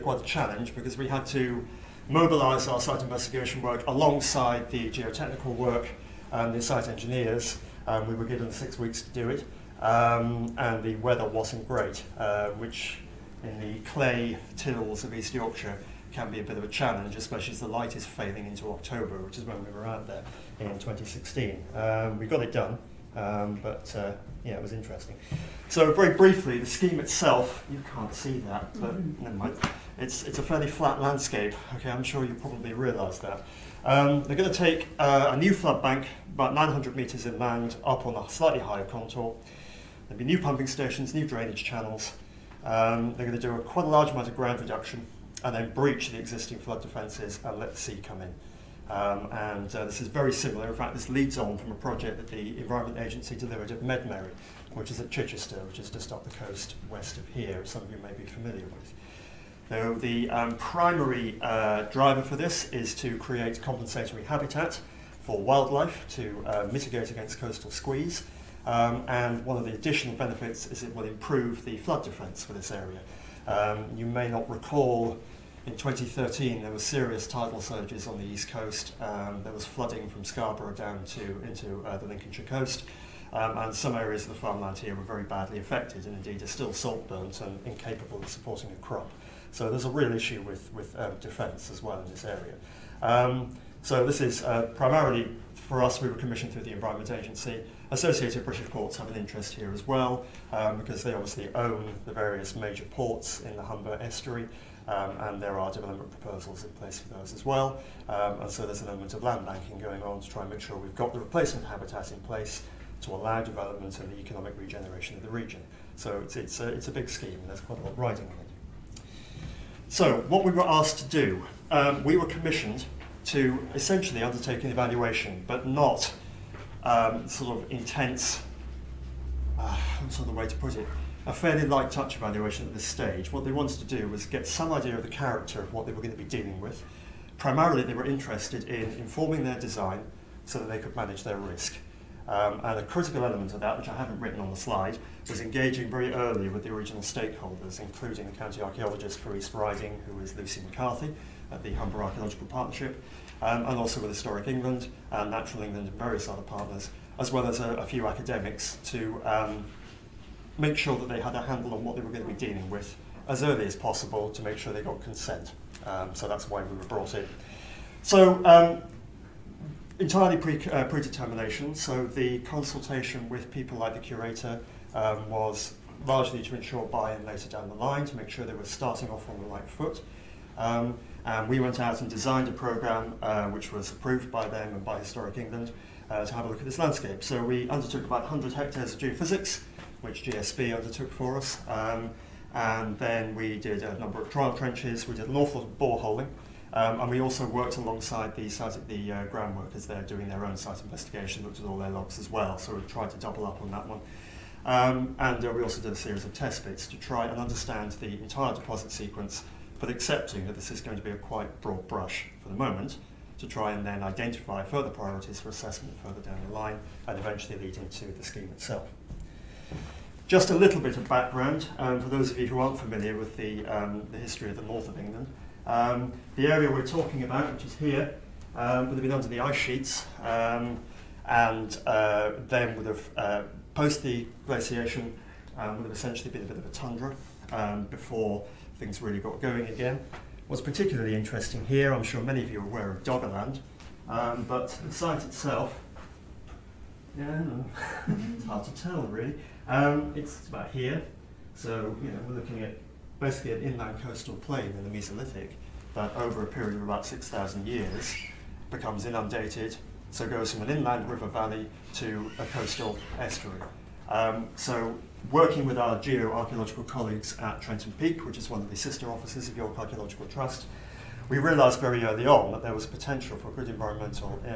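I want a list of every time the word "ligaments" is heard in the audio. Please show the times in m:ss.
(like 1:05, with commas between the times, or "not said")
not said.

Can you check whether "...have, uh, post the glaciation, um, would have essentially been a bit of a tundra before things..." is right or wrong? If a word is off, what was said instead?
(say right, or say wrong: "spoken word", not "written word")
right.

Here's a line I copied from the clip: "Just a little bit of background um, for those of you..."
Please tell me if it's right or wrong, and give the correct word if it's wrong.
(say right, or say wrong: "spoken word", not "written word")
right.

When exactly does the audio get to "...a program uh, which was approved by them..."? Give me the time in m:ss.
3:02.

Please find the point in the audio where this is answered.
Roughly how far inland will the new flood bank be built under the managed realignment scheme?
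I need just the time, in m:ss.
0:36.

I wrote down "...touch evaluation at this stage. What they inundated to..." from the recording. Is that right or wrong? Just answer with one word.
wrong.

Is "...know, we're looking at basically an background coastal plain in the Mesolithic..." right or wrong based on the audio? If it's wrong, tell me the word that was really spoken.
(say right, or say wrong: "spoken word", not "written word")
wrong: "inland", not "background".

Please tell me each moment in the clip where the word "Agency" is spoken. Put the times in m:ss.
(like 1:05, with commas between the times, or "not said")
0:53, 1:37.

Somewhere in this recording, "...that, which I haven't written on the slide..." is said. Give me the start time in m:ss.
2:23.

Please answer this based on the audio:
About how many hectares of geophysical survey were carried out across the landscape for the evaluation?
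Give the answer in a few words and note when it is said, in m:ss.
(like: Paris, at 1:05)
100 hectares, at 3:08.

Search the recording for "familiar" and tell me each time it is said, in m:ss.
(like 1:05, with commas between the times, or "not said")
0:58, 3:42.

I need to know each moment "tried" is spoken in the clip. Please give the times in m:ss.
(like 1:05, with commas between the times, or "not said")
3:22.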